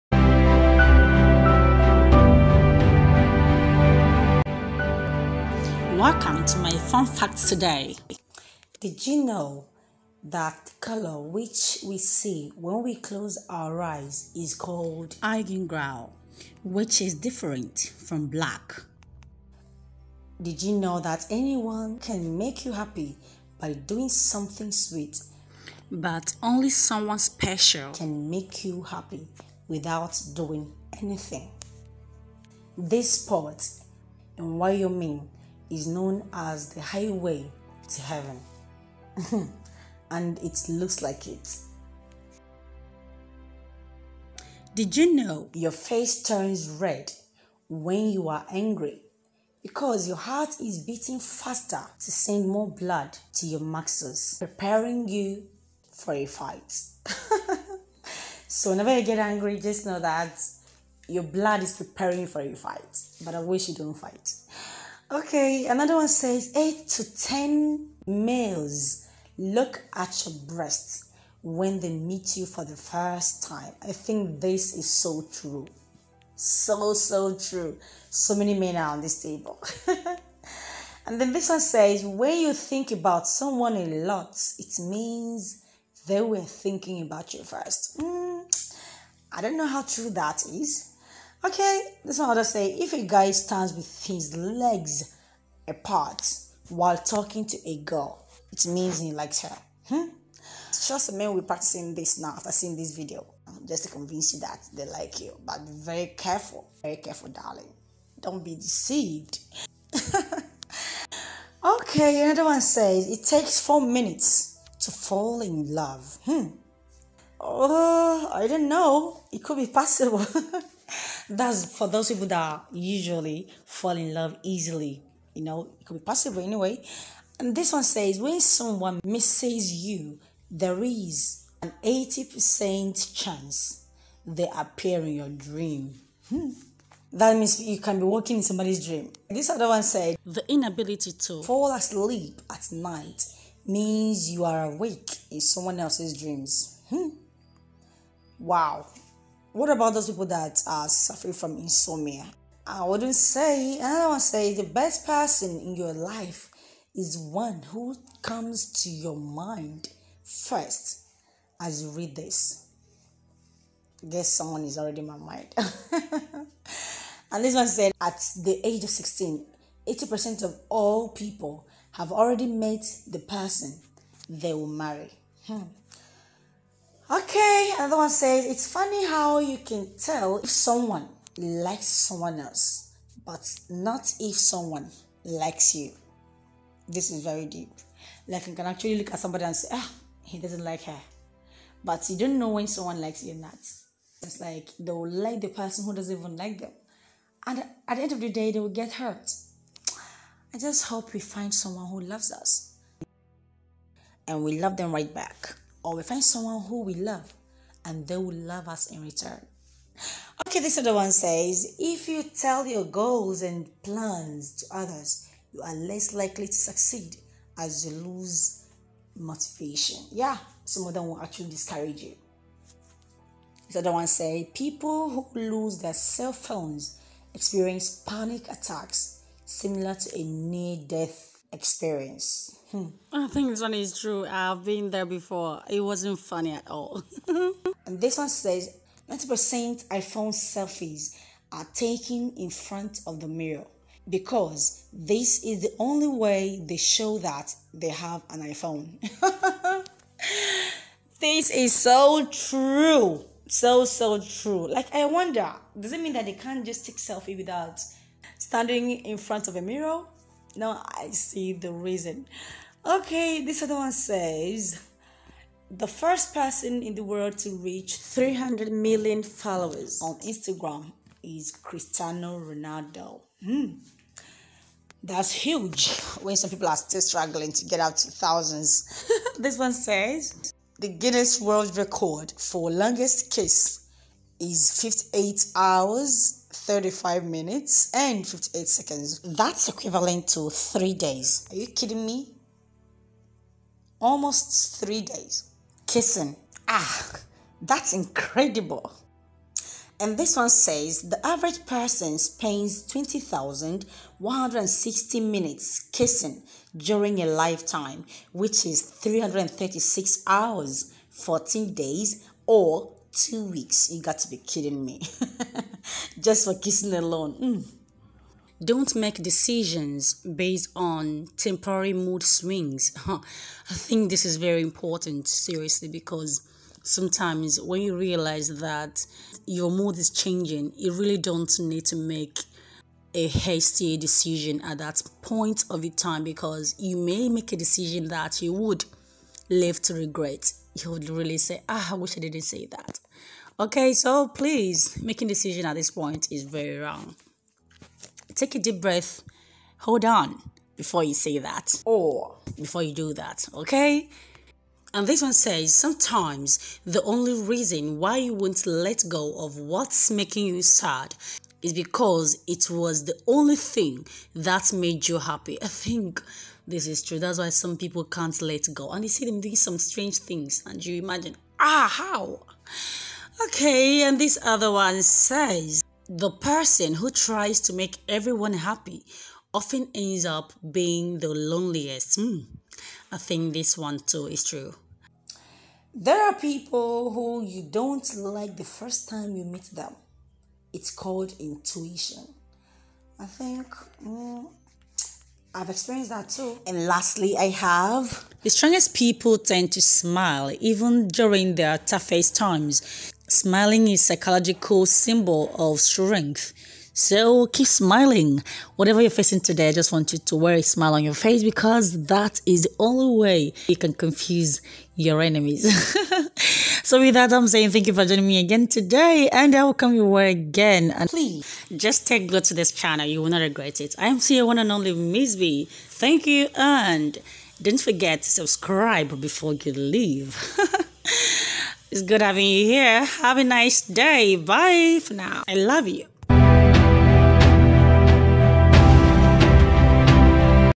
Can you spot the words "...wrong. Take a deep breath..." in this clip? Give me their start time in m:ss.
5:46.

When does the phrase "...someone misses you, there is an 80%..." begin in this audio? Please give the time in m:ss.
2:08.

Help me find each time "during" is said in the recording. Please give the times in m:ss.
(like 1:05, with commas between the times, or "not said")
5:06, 6:41.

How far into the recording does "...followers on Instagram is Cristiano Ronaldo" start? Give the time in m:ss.
4:29.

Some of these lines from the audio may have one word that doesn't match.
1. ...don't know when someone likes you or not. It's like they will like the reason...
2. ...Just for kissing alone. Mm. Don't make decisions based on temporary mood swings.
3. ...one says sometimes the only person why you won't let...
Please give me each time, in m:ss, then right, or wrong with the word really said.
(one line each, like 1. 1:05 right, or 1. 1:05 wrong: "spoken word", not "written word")
1. 3:12 wrong: "person", not "reason"
2. 5:16 right
3. 5:55 wrong: "reason", not "person".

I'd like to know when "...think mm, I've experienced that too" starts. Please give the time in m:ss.
6:33.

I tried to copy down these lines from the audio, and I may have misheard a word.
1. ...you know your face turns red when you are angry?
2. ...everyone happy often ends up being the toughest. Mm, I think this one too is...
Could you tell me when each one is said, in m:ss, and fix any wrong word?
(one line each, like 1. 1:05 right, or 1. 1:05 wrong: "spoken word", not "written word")
1. 0:44 right
2. 6:18 wrong: "loneliest", not "toughest".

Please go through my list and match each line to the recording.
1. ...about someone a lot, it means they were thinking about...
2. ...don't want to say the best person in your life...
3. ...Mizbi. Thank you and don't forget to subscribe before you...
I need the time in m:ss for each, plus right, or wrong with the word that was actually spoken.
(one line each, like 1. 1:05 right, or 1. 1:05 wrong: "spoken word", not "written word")
1. 1:22 right
2. 2:33 right
3. 7:04 right.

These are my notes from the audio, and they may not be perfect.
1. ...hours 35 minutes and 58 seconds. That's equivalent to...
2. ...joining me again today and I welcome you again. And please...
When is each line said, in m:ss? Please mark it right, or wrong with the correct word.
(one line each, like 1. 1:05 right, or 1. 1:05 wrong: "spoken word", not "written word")
1. 4:45 right
2. 6:58 right.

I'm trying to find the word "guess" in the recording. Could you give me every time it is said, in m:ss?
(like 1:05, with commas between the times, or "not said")
2:44.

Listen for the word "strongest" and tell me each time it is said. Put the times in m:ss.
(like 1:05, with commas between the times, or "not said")
6:38.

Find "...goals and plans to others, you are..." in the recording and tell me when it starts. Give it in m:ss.
3:32.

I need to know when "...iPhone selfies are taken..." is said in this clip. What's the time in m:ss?
3:59.